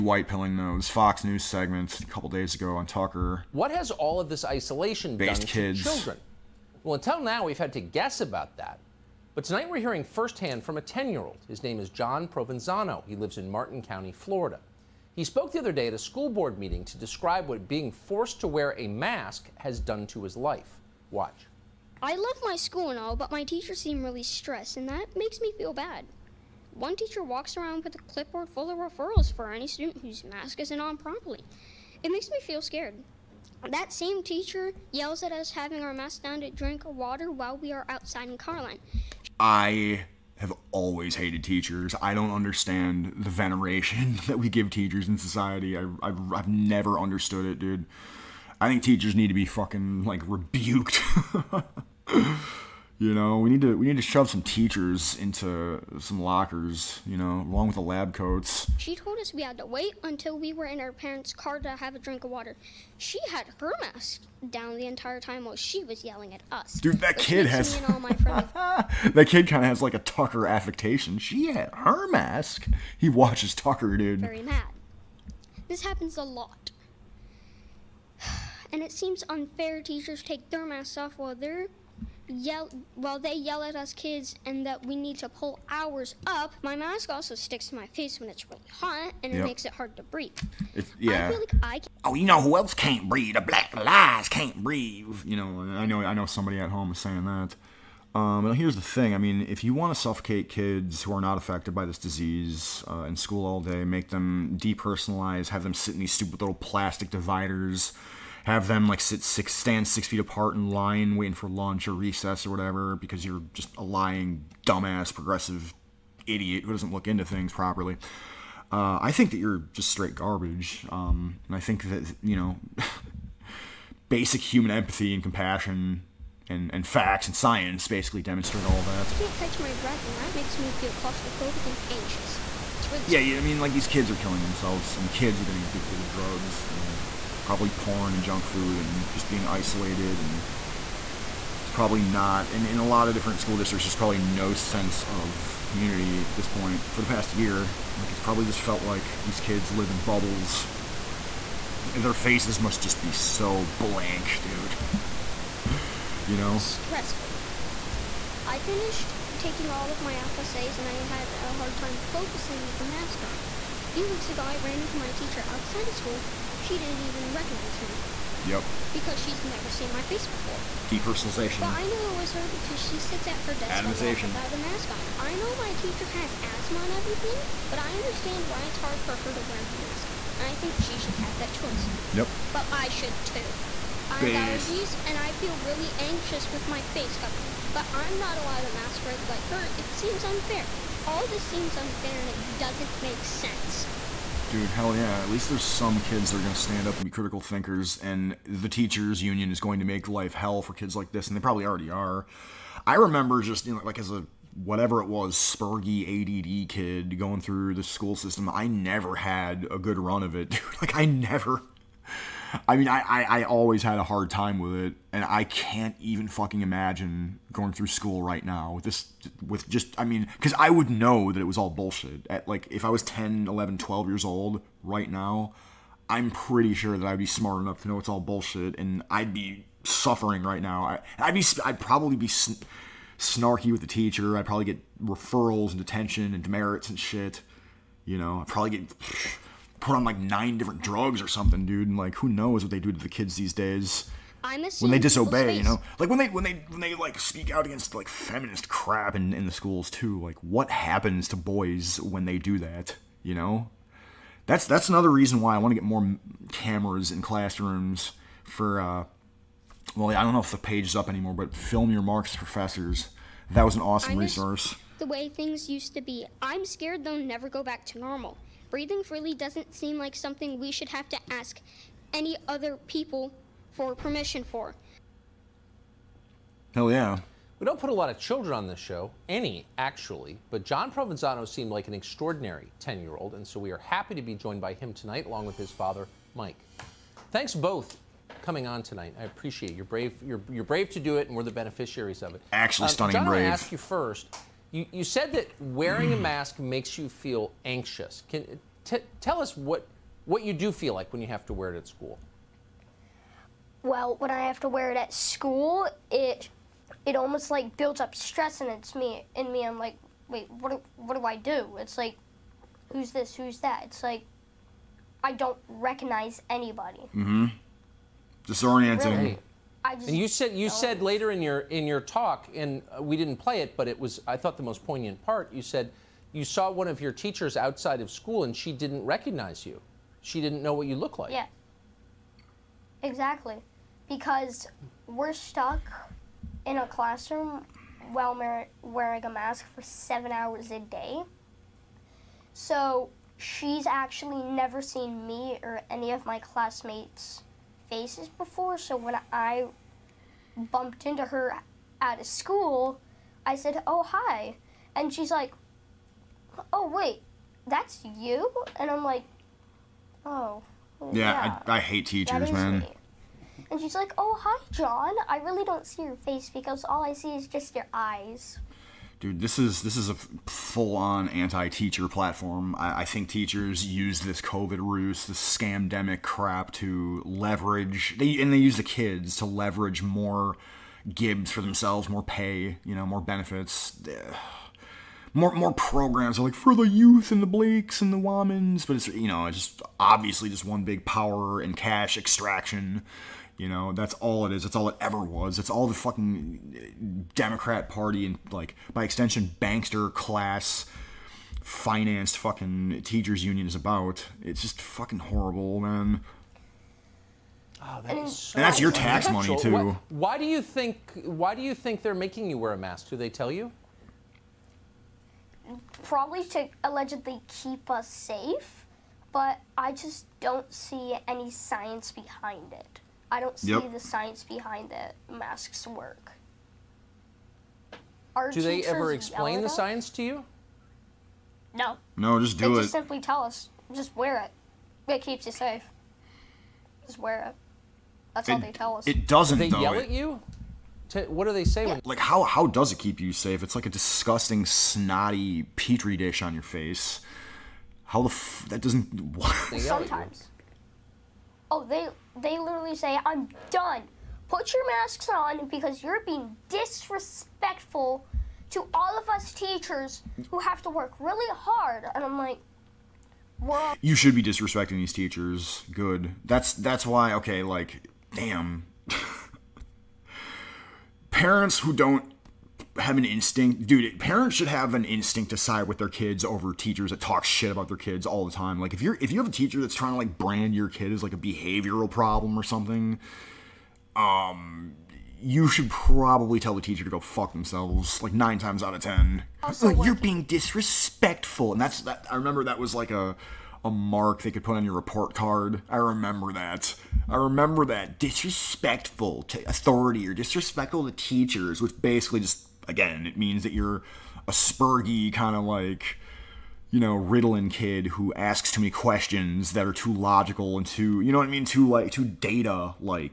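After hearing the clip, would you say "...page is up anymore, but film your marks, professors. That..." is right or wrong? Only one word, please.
right.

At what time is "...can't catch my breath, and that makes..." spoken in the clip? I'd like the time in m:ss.
2:09.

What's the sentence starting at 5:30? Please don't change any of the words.
She didn't know what you look like.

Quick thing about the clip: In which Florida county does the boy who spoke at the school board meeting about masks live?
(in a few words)
Martin County.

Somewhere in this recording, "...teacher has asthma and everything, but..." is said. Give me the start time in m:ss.
2:55.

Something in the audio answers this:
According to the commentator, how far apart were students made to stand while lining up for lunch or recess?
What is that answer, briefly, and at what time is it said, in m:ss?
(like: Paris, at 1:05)
6 feet, at 1:49.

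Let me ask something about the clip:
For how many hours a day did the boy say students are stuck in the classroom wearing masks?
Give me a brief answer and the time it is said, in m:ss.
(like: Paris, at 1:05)
7 hours, at 5:39.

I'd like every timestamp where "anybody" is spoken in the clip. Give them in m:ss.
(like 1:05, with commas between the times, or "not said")
5:16.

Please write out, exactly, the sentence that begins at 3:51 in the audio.
I, would be, I'd probably be sn- snarky with the teacher.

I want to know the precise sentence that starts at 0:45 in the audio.
I, I've, I've never understood it, dude.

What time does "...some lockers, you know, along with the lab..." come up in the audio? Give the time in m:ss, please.
0:55.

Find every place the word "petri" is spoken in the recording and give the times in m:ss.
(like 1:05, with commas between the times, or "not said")
7:25.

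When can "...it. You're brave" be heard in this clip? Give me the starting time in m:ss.
4:49.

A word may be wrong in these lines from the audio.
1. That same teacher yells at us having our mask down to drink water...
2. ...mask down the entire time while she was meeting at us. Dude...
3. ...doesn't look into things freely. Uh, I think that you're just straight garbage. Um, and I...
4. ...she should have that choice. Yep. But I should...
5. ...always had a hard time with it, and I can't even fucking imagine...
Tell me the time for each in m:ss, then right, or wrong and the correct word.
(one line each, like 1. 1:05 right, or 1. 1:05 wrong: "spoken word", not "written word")
1. 0:33 right
2. 1:03 wrong: "yelling", not "meeting"
3. 1:56 wrong: "properly", not "freely"
4. 3:00 right
5. 3:33 right.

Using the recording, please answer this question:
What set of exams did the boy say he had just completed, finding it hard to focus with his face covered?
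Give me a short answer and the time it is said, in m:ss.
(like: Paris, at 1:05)
FSAs, at 2:40.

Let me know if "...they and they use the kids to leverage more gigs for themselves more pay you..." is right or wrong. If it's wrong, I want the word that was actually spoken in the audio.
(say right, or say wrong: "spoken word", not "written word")
right.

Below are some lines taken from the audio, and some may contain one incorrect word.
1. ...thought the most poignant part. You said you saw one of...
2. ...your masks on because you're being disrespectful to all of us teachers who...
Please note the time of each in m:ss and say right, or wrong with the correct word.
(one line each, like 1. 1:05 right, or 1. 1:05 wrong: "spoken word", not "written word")
1. 5:24 right
2. 7:34 right.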